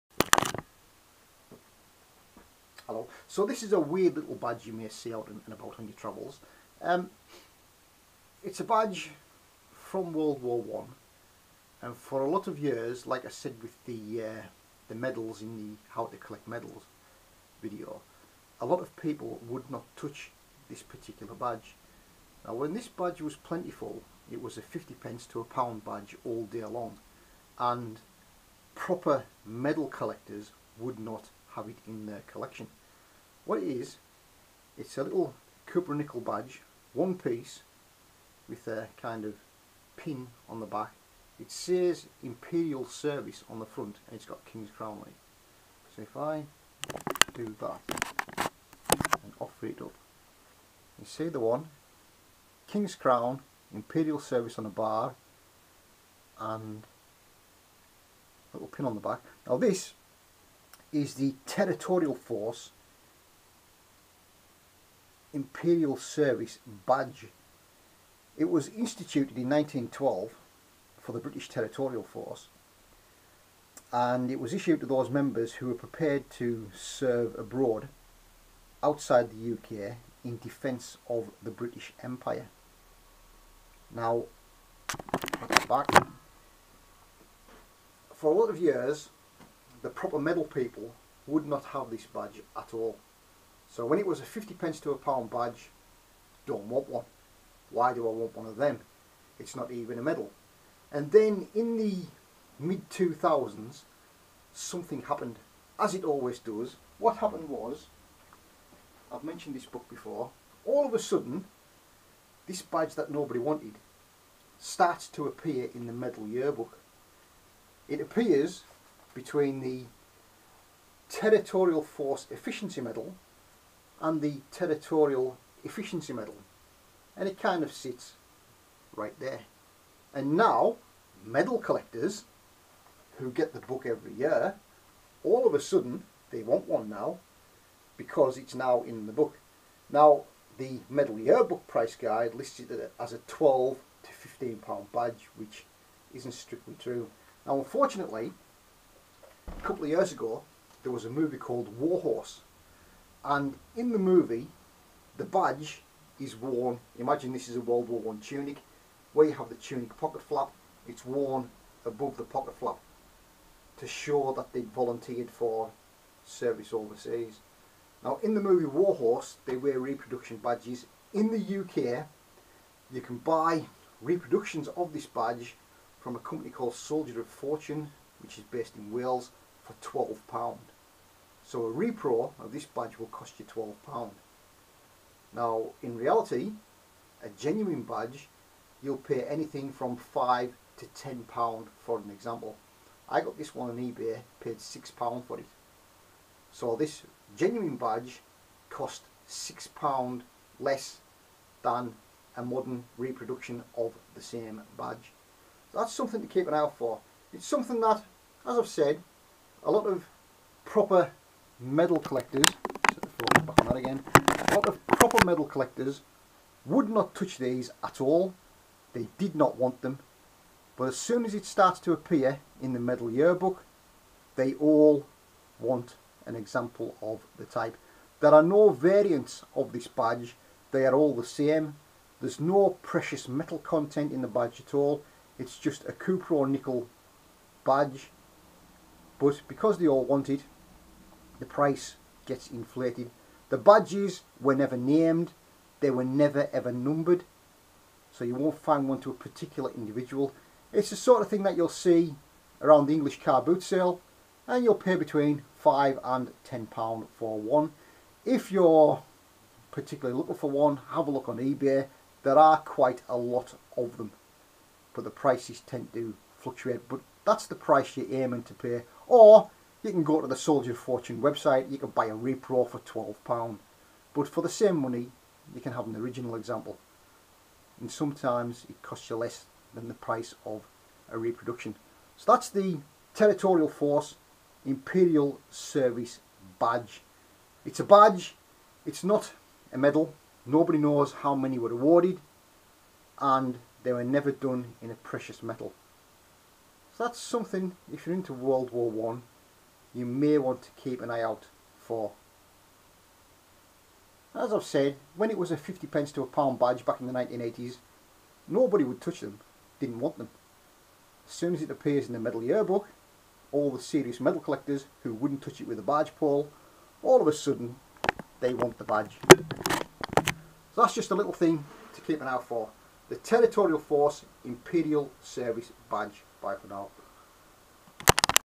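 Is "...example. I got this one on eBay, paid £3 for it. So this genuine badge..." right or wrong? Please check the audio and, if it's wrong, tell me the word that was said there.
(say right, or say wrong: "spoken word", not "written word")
wrong: "6", not "3".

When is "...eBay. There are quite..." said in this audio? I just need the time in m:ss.
4:21.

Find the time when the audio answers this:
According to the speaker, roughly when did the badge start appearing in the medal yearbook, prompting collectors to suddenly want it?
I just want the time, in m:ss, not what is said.
1:42.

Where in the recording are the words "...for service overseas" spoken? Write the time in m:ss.
2:45.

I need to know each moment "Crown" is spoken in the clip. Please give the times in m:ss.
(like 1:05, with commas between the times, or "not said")
0:44, 0:52.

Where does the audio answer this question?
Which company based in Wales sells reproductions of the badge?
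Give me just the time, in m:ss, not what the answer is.
2:56.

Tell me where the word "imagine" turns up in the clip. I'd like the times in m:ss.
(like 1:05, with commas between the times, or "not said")
2:36.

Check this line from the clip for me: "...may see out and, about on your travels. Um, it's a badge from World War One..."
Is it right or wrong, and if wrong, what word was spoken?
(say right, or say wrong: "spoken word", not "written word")
right.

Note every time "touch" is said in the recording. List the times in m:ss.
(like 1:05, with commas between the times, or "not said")
0:19, 3:37, 5:09, 5:15.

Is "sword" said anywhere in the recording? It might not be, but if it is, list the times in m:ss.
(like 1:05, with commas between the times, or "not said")
not said.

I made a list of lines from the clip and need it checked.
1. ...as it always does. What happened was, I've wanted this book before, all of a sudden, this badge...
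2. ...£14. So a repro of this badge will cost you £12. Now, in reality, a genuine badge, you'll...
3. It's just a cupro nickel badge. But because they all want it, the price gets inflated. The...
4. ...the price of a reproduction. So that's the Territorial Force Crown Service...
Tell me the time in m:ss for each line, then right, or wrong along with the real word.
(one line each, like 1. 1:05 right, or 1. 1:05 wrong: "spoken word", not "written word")
1. 1:45 wrong: "mentioned", not "wanted"
2. 3:00 wrong: "12", not "14"
3. 3:55 right
4. 4:39 wrong: "Imperial", not "Crown".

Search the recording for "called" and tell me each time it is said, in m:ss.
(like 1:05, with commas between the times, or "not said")
2:31, 2:56.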